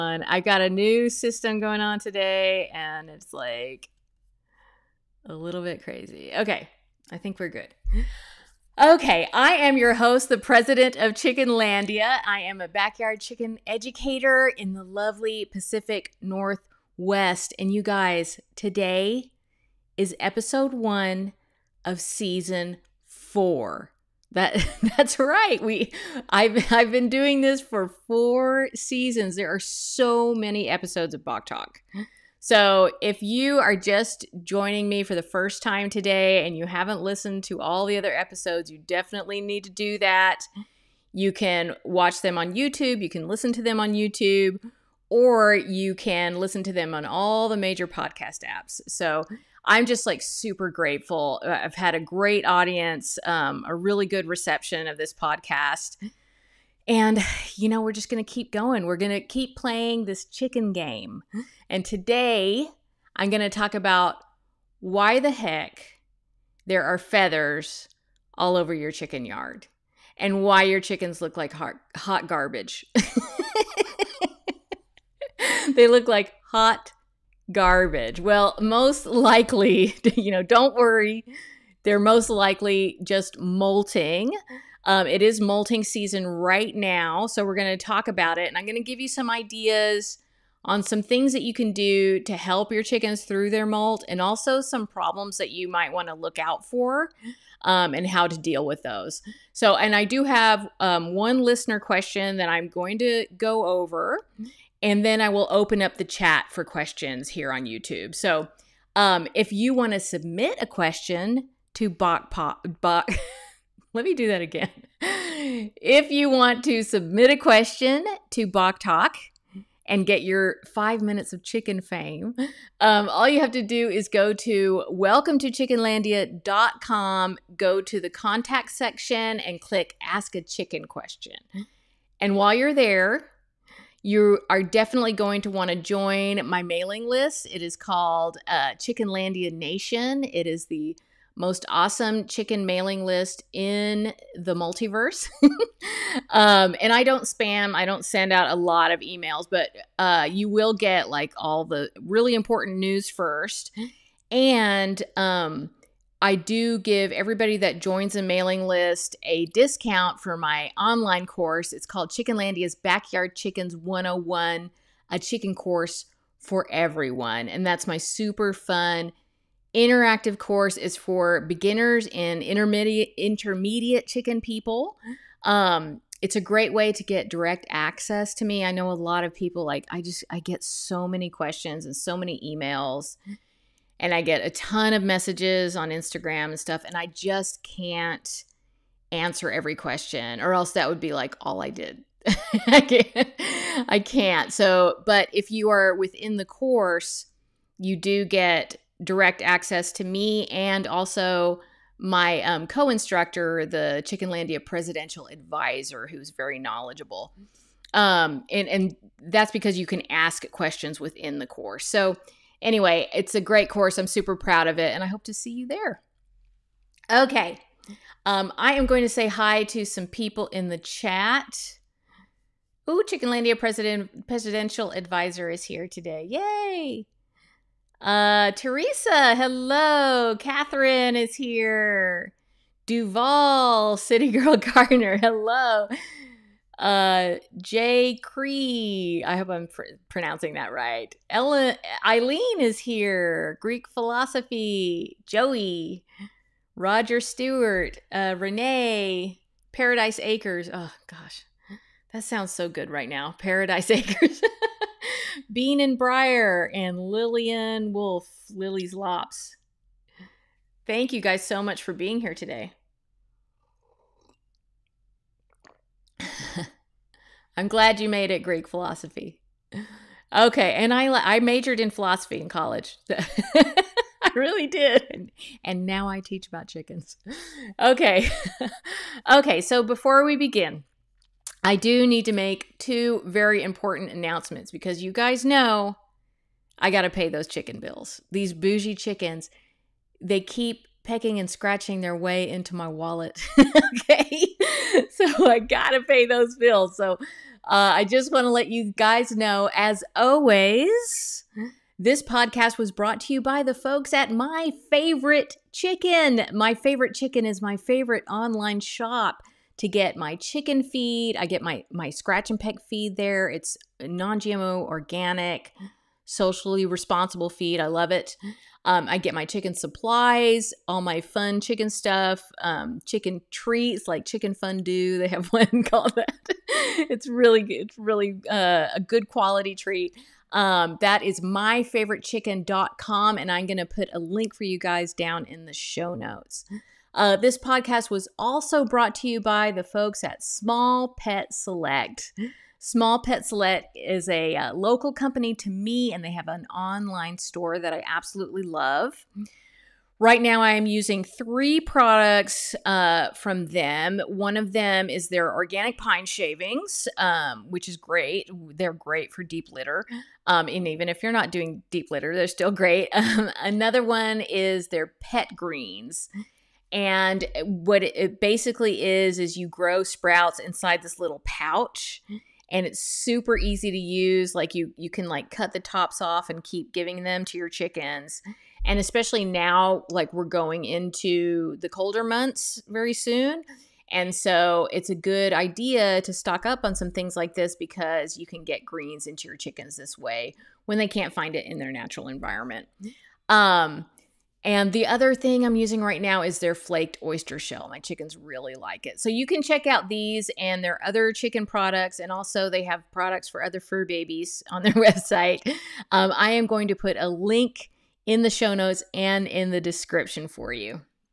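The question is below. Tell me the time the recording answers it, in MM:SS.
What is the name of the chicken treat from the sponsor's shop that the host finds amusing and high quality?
05:24.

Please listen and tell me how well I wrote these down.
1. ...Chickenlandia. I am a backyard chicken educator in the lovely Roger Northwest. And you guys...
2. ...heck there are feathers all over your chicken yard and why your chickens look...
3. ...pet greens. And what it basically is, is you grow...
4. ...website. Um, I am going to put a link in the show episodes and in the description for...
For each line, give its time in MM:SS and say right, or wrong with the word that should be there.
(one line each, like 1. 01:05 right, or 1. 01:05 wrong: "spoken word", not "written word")
1. 00:11 wrong: "Pacific", not "Roger"
2. 01:05 right
3. 06:05 right
4. 06:44 wrong: "notes", not "episodes".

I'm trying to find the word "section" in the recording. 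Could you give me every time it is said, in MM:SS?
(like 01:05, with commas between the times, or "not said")
02:08.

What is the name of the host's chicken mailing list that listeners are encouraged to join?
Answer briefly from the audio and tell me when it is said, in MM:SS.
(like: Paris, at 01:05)
Chickenlandia Nation, at 02:18.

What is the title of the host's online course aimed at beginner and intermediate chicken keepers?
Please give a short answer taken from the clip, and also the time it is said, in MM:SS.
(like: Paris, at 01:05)
Chickenlandia's Backyard Chickens 101, at 02:42.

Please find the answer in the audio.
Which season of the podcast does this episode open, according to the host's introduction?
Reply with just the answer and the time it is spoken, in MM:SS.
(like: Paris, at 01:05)
Season 4, at 00:22.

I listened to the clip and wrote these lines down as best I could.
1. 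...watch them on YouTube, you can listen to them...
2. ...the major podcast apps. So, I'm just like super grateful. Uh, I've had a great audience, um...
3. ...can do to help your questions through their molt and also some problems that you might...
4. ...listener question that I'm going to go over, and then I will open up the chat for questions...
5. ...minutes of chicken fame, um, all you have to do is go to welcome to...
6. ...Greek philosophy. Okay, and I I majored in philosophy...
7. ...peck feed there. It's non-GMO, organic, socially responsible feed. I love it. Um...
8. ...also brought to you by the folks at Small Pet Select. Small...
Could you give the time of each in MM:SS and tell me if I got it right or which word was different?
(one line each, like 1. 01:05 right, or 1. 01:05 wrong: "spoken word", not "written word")
1. 00:41 right
2. 00:47 right
3. 01:31 wrong: "chickens", not "questions"
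4. 01:41 right
5. 02:01 right
6. 04:28 right
7. 05:12 right
8. 05:38 right.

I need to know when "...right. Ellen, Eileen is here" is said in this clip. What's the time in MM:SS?
04:00.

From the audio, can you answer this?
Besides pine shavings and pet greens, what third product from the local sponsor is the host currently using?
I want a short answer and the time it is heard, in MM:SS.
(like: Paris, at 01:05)
Flaked oyster shell, at 06:36.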